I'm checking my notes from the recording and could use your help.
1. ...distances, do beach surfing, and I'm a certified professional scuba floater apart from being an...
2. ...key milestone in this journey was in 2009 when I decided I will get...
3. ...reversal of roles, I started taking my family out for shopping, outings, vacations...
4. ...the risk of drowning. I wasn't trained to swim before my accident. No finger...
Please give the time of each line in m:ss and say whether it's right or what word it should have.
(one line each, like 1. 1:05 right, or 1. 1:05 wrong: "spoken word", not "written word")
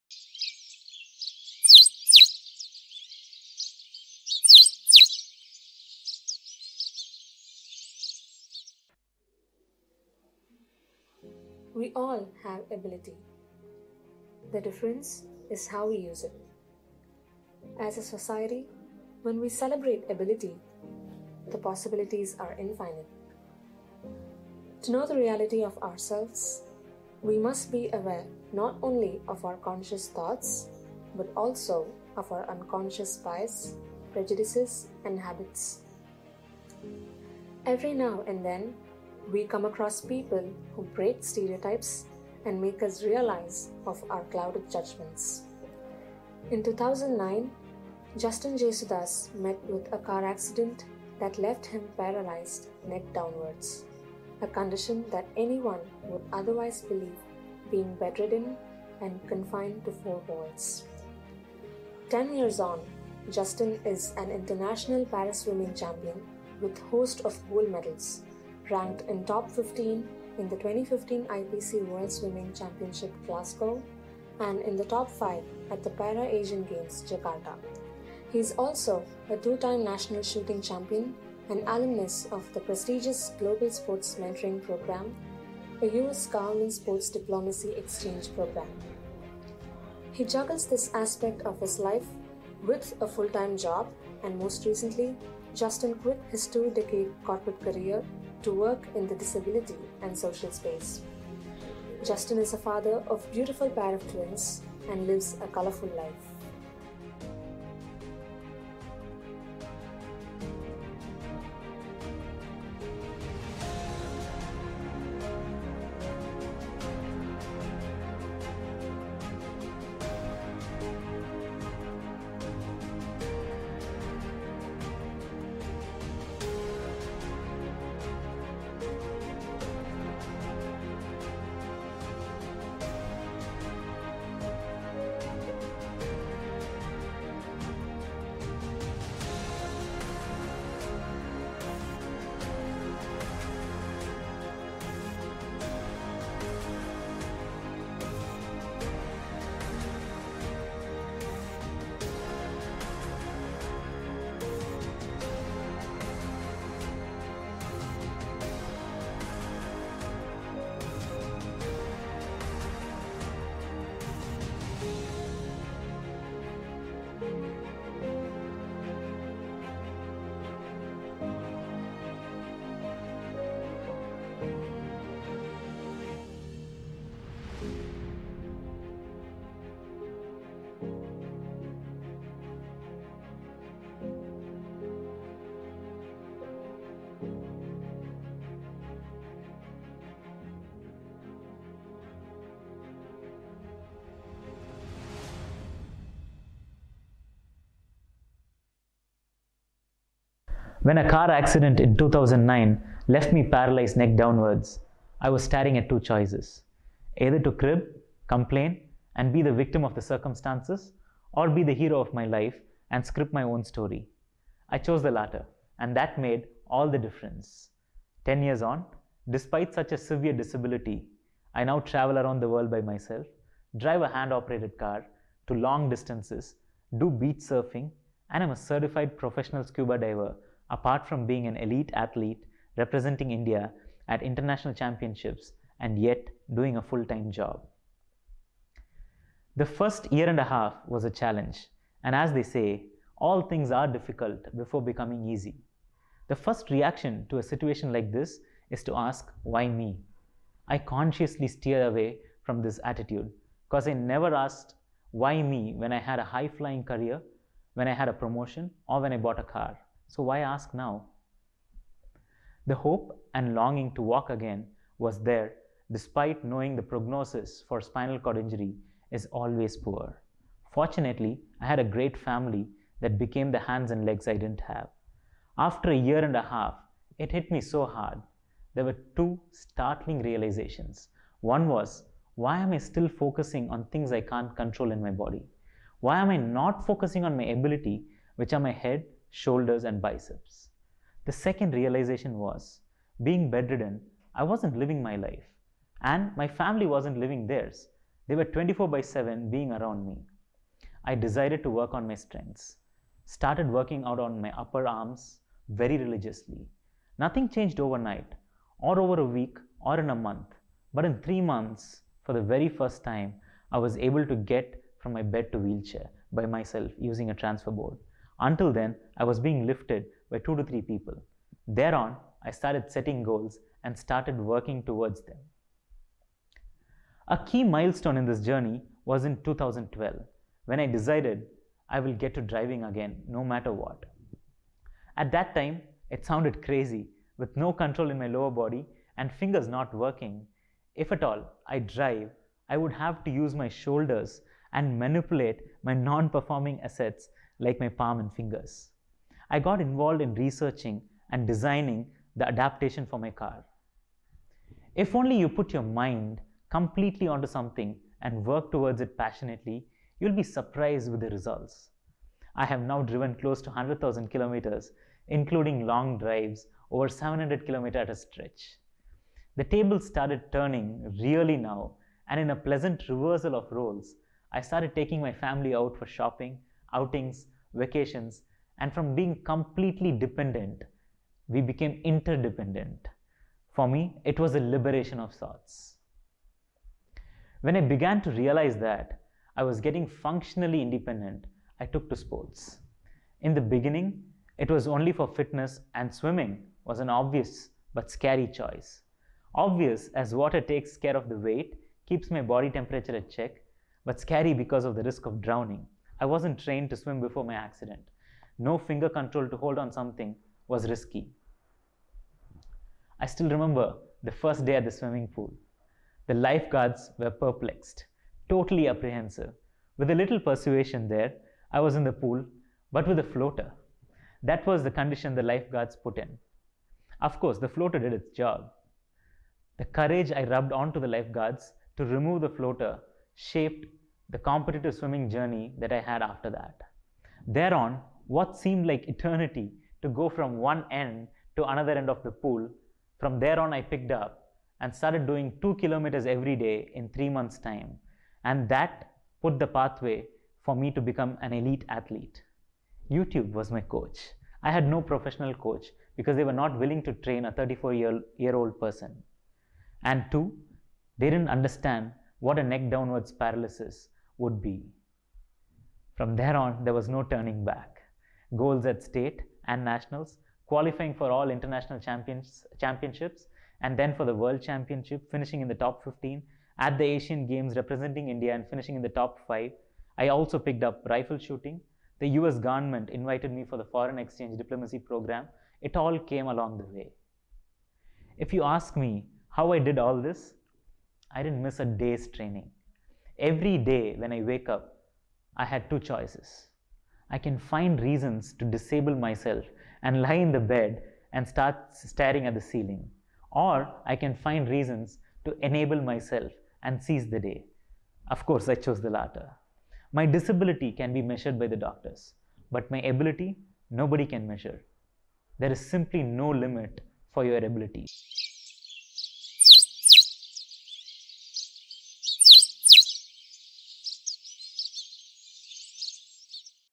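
1. 3:45 wrong: "diver", not "floater"
2. 5:27 wrong: "2012", not "2009"
3. 6:13 right
4. 6:44 right.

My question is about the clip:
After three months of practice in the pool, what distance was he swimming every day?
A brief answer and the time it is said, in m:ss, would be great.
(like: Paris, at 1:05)
2 kilometers, at 7:25.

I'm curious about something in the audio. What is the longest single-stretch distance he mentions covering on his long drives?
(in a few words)
700 kilometers.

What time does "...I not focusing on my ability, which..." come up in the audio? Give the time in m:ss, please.
4:46.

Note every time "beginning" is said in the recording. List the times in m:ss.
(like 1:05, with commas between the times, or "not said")
6:33.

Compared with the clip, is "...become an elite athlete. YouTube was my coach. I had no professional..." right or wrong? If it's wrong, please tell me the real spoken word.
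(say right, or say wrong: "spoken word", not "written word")
right.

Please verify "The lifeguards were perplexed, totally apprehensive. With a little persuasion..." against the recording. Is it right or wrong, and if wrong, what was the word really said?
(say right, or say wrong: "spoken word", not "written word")
right.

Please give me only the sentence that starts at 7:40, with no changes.
And two, they didn't understand what a neck downwards paralysis would be.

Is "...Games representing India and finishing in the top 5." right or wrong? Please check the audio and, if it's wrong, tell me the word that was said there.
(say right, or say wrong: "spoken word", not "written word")
right.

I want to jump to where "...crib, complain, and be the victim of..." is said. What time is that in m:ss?
3:27.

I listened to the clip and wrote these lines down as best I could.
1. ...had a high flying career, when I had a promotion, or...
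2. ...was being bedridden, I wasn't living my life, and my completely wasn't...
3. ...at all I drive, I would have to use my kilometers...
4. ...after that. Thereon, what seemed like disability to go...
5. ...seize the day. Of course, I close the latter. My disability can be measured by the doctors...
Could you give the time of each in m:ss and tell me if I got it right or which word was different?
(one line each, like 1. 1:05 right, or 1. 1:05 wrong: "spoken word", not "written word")
1. 4:15 right
2. 4:52 wrong: "family", not "completely"
3. 5:41 wrong: "shoulders", not "kilometers"
4. 7:16 wrong: "eternity", not "disability"
5. 8:27 wrong: "chose", not "close".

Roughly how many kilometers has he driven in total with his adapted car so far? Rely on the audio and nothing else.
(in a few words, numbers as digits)
100,000 kilometers.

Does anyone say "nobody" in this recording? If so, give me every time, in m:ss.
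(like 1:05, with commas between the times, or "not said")
8:33.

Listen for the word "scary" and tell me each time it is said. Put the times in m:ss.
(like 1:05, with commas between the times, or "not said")
6:38, 6:44.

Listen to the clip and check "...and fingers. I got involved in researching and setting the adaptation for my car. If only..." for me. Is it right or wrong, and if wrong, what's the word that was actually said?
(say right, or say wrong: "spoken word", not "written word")
wrong: "designing", not "setting".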